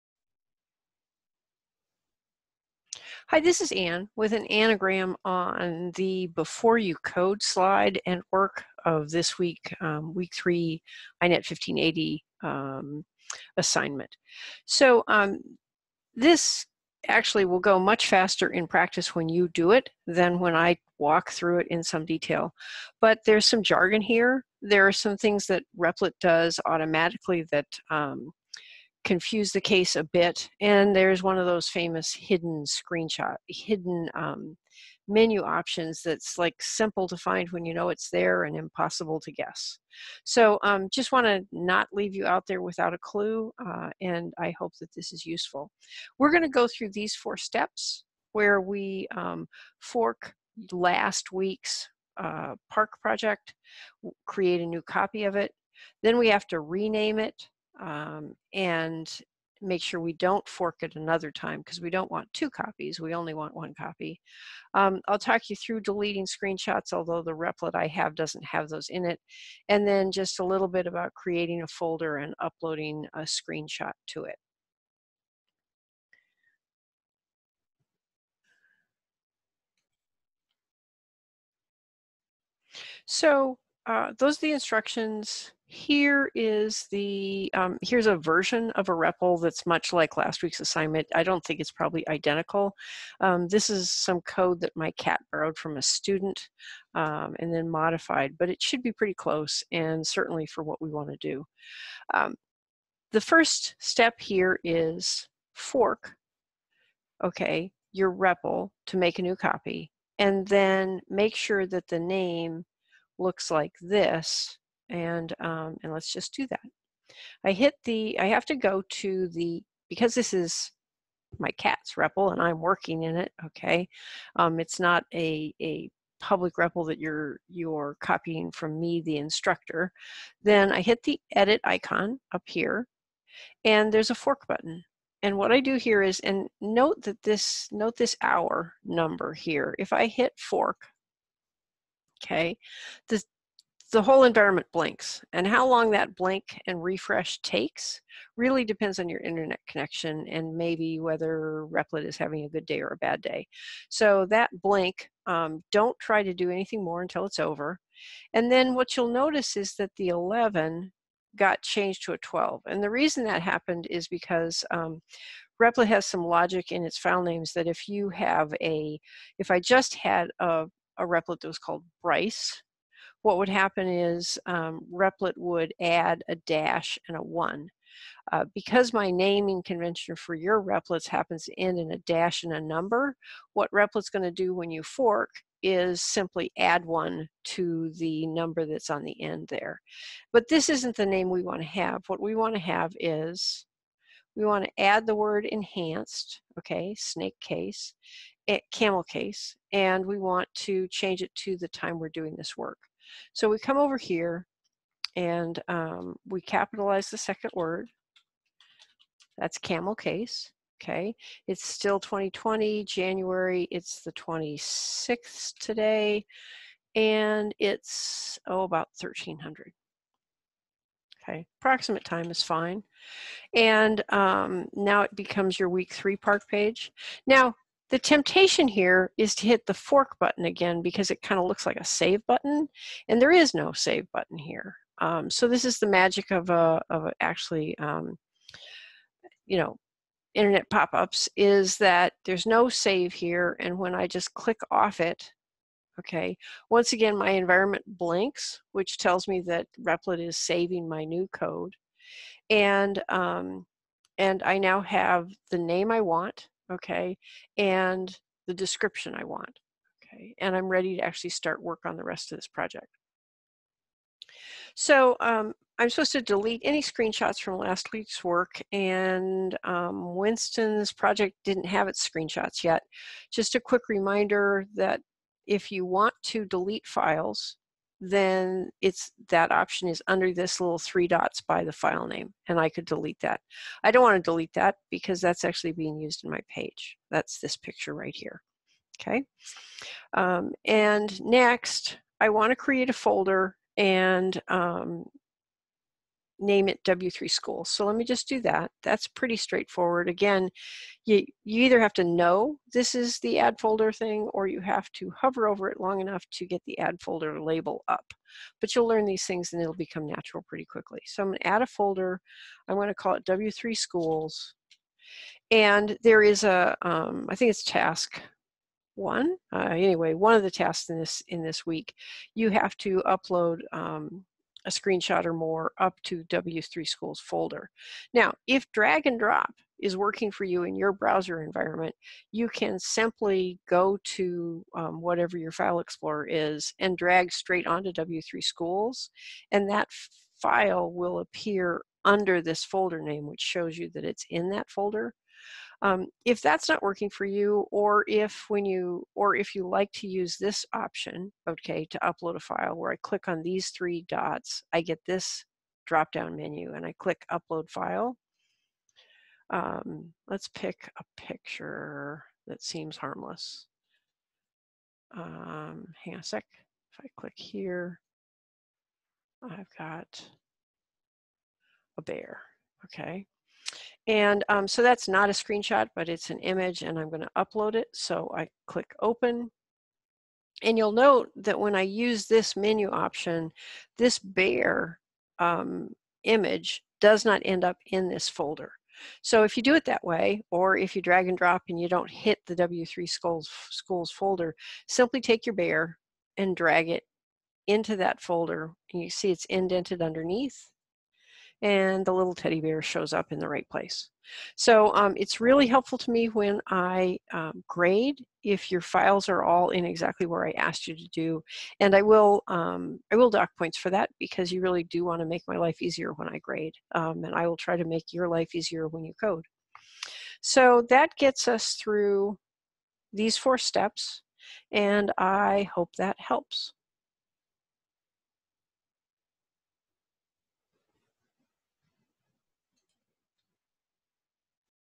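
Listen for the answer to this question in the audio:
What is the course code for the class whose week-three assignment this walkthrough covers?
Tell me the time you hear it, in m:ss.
0:11.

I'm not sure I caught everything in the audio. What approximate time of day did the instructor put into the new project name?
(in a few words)
1300.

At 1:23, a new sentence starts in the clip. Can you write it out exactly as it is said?
So uh, those are the instructions.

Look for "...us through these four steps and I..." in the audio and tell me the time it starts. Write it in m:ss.
7:01.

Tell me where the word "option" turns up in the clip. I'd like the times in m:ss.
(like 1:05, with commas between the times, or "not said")
0:35, 4:39, 5:50, 6:22.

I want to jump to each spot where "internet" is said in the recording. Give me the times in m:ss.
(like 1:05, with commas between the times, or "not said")
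2:29, 4:00.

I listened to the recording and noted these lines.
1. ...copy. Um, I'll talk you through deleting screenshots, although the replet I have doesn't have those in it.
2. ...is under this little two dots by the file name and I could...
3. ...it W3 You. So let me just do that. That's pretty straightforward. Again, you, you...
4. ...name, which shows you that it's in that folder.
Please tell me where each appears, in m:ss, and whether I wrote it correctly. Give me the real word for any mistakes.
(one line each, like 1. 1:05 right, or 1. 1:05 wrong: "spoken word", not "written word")
1. 1:03 right
2. 4:39 wrong: "three", not "two"
3. 4:56 wrong: "School", not "You"
4. 5:43 right.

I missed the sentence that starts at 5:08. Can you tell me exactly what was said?
But you'll learn these things and it'll become natural pretty quickly.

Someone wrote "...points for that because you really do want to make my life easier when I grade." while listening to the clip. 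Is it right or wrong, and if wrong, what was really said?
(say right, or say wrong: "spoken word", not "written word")
right.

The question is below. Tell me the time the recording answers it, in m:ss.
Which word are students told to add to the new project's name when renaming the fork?
3:15.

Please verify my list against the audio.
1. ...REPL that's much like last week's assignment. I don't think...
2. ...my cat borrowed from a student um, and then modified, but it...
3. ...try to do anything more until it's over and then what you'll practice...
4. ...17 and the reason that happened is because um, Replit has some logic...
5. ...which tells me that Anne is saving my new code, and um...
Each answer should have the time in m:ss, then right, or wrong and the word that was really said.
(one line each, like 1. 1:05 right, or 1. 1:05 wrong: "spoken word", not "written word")
1. 1:28 right
2. 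1:34 right
3. 2:35 wrong: "notice", not "practice"
4. 2:42 wrong: "12", not "17"
5. 4:08 wrong: "Replit", not "Anne".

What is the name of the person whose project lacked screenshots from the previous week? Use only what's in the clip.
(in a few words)
Winston.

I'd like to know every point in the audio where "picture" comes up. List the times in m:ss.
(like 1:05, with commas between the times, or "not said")
4:47, 6:01.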